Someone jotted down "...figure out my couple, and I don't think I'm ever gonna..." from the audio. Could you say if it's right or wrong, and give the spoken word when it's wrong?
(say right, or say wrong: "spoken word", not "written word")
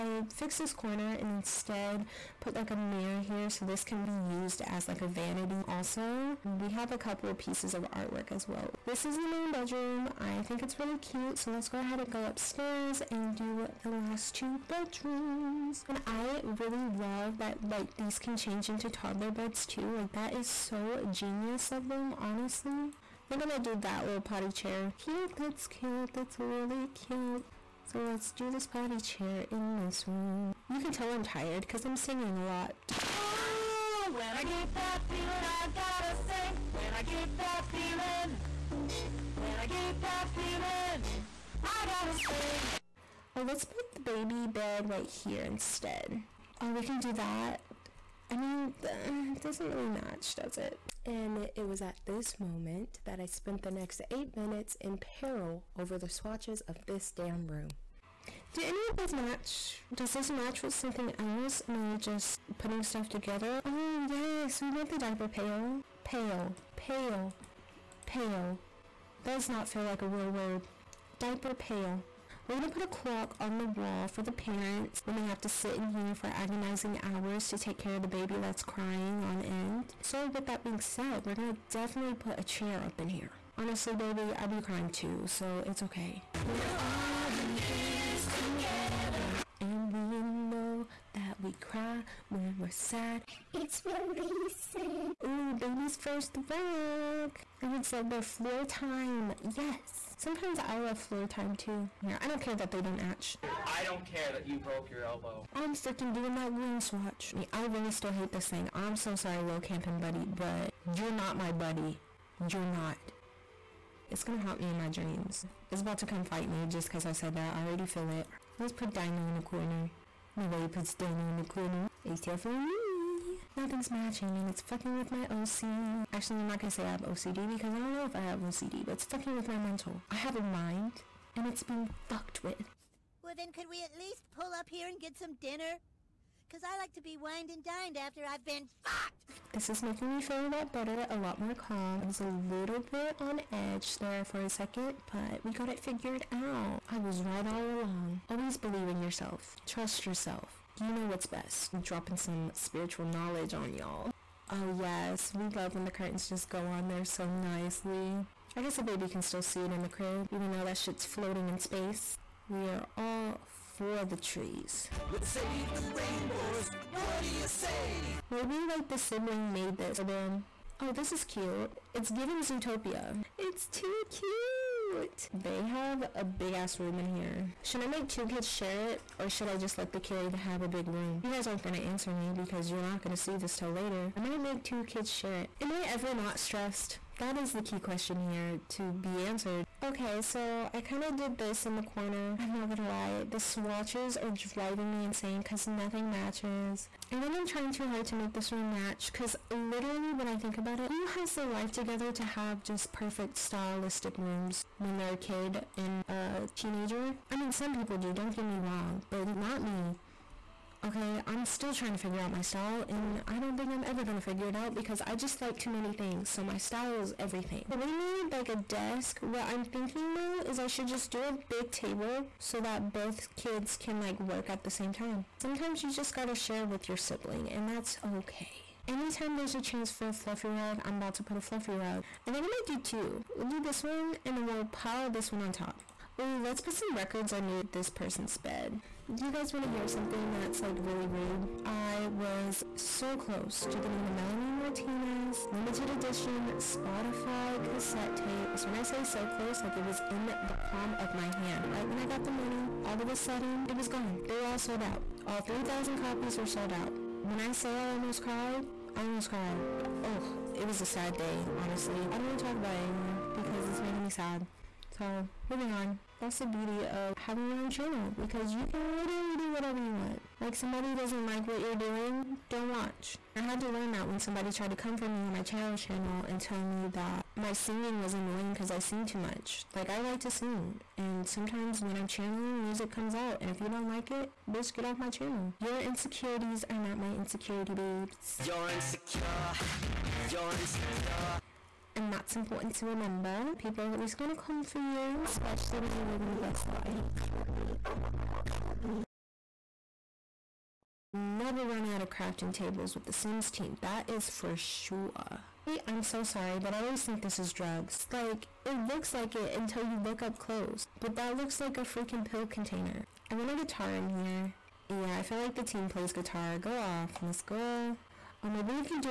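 wrong: "style", not "couple".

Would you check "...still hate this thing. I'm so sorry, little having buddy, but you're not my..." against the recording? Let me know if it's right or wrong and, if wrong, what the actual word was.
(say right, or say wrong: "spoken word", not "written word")
wrong: "camping", not "having".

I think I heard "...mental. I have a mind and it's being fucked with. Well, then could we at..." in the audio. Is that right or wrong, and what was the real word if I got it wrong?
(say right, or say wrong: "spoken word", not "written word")
right.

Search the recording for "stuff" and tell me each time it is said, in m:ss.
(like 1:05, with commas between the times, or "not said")
1:02.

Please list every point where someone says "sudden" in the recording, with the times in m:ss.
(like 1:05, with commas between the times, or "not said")
4:13.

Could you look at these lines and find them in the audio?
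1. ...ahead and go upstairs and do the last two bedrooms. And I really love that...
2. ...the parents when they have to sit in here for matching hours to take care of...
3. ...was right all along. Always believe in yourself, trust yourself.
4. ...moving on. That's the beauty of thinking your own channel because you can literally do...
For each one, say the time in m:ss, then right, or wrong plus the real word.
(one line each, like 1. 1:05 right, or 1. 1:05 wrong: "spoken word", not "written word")
1. 0:11 right
2. 1:14 wrong: "agonizing", not "matching"
3. 2:26 right
4. 4:25 wrong: "having", not "thinking".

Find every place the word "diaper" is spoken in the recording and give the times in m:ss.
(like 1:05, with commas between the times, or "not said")
1:04, 1:11.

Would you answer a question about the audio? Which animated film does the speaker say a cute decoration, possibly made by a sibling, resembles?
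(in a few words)
Zootopia.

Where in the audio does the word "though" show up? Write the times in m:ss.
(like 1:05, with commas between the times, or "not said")
2:40, 3:40.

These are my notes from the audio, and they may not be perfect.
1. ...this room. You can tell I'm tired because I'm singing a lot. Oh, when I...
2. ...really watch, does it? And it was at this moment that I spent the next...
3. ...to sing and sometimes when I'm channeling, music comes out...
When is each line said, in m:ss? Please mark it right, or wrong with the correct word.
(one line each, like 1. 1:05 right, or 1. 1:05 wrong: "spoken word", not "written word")
1. 0:29 right
2. 0:49 wrong: "match", not "watch"
3. 4:40 right.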